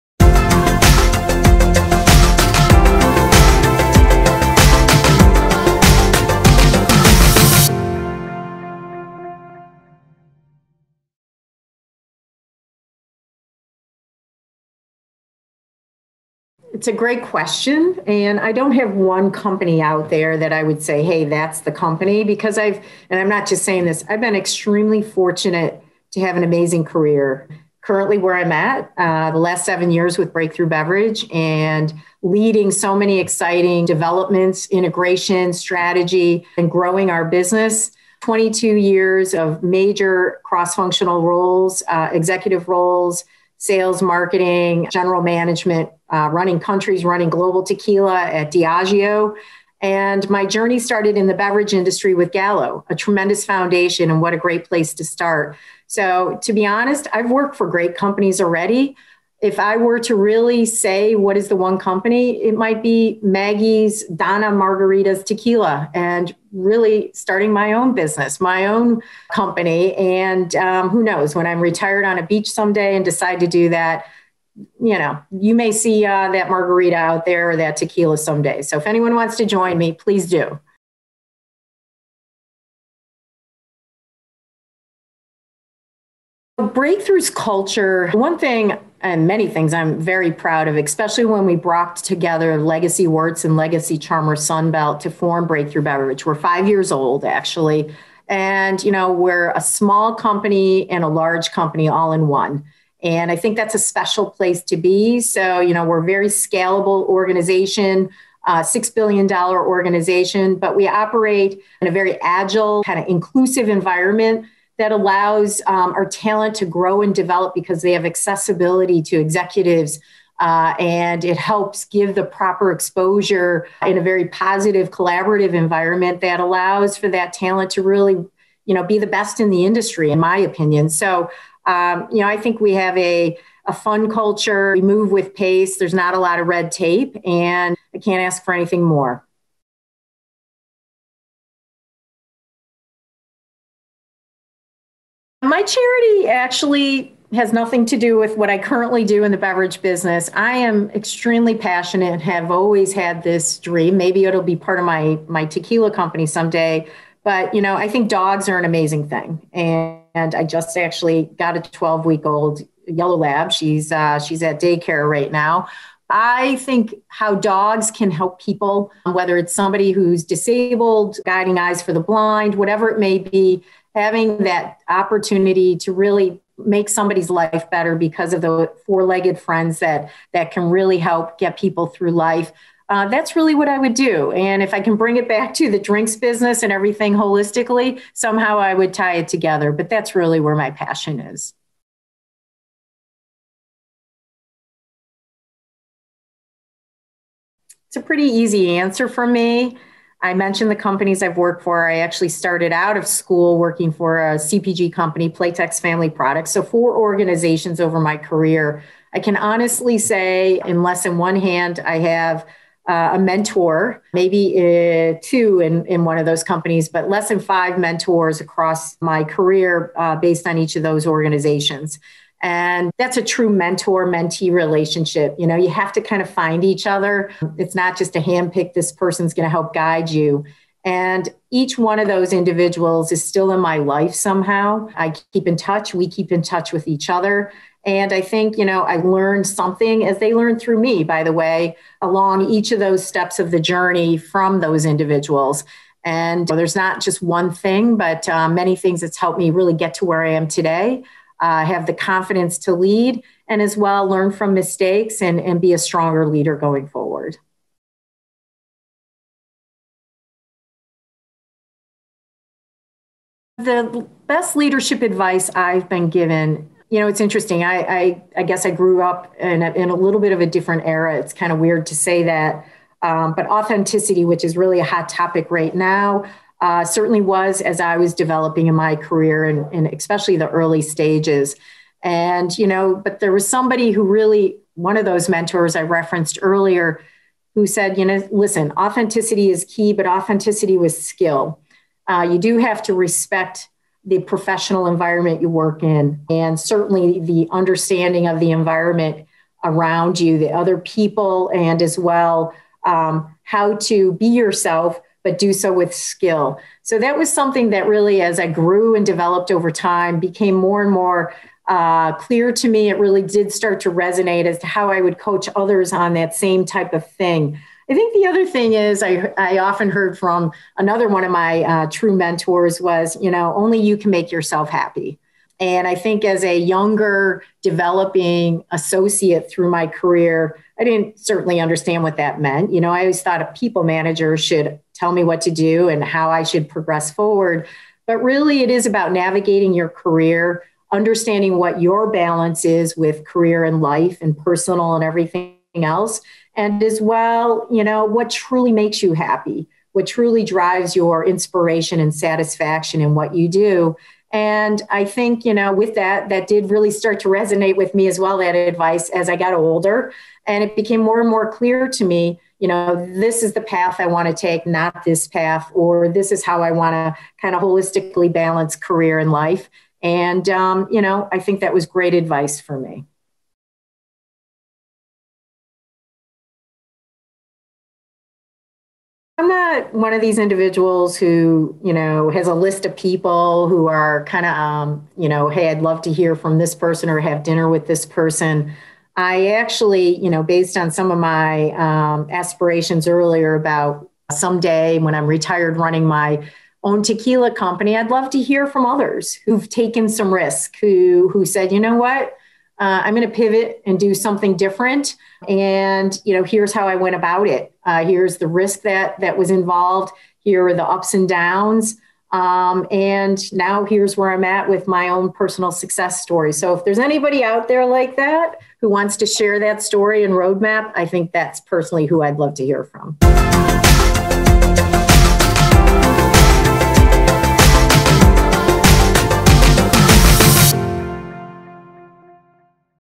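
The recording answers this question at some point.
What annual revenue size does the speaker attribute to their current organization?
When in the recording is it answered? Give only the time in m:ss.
1:48.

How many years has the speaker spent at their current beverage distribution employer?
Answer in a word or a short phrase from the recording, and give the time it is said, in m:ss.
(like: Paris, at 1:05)
7, at 0:29.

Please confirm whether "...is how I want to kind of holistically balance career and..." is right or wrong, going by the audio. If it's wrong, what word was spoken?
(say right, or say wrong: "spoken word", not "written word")
right.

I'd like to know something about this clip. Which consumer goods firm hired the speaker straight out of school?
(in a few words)
Playtex Family Products.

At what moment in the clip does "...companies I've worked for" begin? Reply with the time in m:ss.
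3:20.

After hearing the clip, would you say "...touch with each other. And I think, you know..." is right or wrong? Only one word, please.
right.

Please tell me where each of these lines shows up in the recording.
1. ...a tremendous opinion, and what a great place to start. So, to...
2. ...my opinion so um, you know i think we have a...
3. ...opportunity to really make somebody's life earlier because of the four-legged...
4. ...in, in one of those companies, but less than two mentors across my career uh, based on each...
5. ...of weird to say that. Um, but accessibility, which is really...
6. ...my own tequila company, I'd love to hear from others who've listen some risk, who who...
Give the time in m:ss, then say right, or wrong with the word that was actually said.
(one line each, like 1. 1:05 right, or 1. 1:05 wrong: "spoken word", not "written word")
1. 0:52 wrong: "foundation", not "opinion"
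2. 2:10 right
3. 2:54 wrong: "better", not "earlier"
4. 3:35 wrong: "five", not "two"
5. 4:31 wrong: "authenticity", not "accessibility"
6. 6:36 wrong: "taken", not "listen".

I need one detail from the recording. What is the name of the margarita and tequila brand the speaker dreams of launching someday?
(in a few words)
Maggie's Donna Margaritas.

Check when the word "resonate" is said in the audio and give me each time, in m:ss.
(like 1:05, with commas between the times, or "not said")
5:13, 5:57.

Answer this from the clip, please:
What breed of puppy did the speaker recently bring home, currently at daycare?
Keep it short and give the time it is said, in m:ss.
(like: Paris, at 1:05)
Yellow lab, at 2:42.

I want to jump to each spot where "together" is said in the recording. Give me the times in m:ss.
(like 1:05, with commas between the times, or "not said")
1:31, 3:09.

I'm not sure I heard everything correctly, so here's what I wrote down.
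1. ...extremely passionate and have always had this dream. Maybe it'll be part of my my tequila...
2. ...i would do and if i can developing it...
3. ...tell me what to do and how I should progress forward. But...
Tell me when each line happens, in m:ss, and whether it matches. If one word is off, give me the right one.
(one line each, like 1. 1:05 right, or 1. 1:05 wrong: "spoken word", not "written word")
1. 2:30 right
2. 3:03 wrong: "bring", not "developing"
3. 5:34 right.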